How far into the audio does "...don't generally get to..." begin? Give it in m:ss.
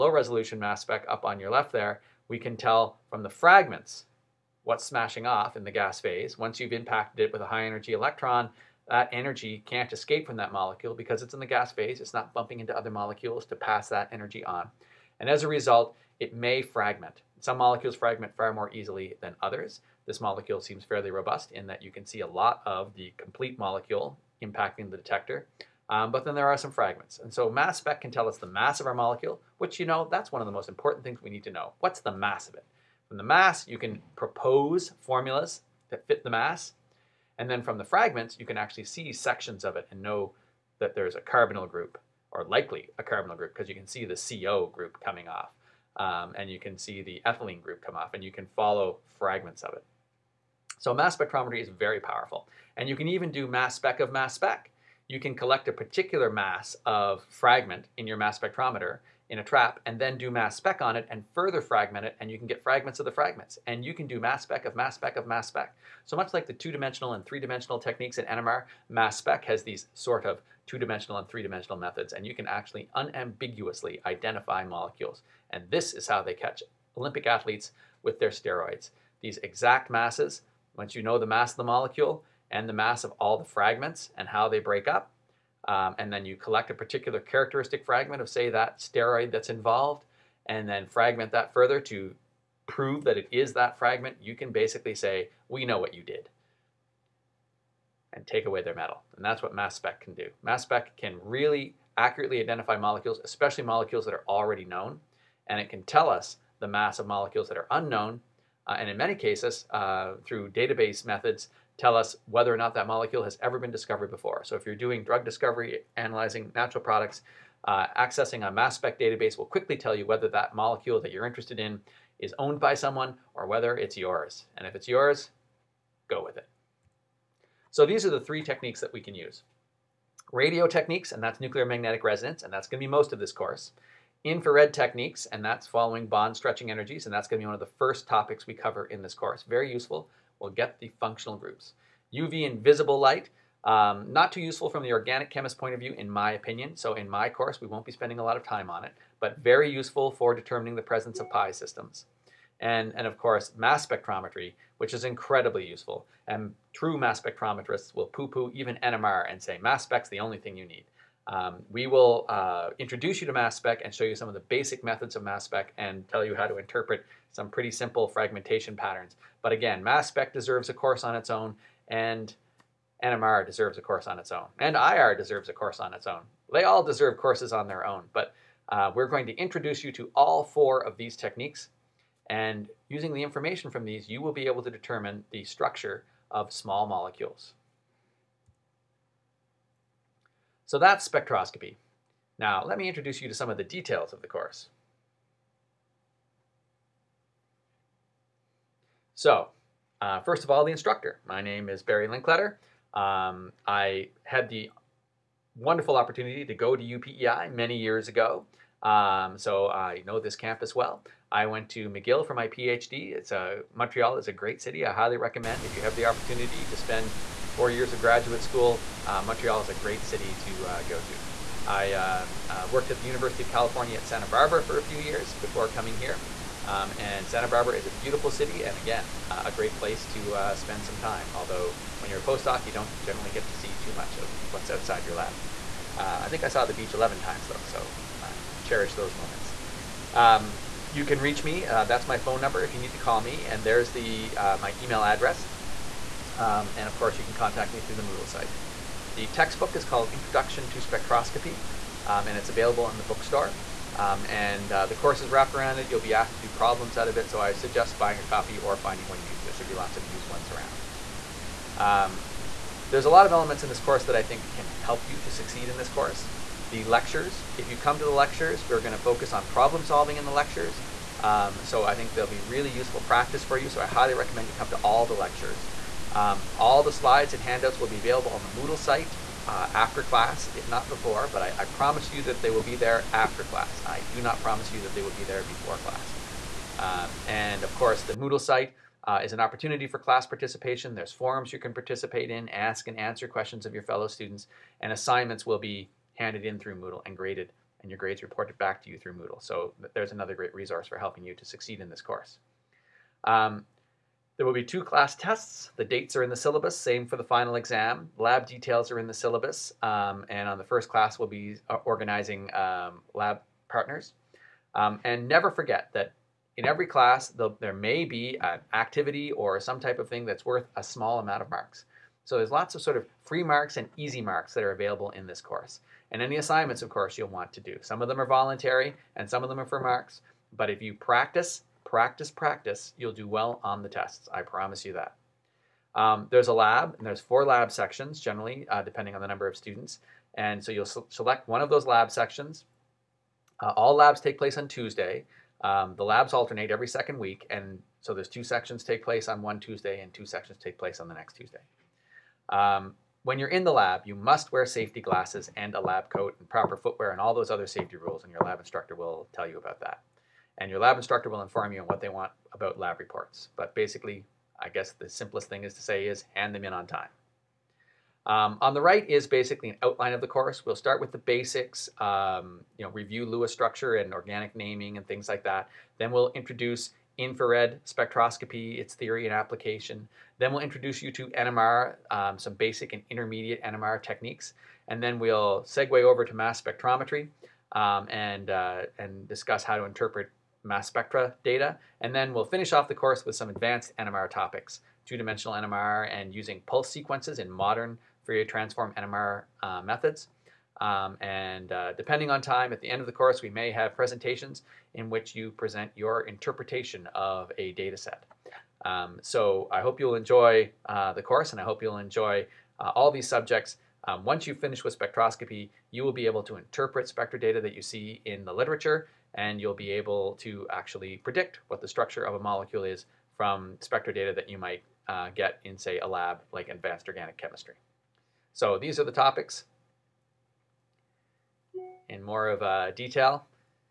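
3:52.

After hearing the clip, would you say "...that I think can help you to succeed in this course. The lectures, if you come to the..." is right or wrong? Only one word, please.
right.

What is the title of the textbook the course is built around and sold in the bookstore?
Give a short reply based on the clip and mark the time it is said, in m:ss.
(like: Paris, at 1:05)
Introduction to Spectroscopy, at 4:10.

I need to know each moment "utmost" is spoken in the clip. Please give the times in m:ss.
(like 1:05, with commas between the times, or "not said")
not said.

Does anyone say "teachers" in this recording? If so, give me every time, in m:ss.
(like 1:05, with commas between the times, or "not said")
not said.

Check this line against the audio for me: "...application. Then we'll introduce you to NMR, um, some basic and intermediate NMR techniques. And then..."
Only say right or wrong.
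right.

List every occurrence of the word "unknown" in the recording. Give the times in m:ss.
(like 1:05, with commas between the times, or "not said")
1:47.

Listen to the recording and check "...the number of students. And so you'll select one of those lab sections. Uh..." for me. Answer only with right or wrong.
right.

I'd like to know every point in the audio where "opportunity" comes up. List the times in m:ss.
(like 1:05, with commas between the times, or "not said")
3:25, 3:36, 4:49.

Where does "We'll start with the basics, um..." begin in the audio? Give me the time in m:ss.
6:10.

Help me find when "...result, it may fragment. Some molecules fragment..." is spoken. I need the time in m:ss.
0:15.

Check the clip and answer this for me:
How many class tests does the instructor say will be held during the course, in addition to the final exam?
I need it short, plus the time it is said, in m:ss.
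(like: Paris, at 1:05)
2, at 5:04.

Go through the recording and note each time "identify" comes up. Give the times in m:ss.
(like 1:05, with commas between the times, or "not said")
1:14, 1:42.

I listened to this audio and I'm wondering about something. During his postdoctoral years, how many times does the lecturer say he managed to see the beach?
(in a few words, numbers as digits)
11.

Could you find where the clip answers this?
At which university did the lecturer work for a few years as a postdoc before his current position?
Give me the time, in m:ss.
3:43.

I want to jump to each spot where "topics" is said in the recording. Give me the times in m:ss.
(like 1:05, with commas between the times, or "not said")
2:18, 6:34, 7:09.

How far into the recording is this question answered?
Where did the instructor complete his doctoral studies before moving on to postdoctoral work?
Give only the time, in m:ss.
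3:31.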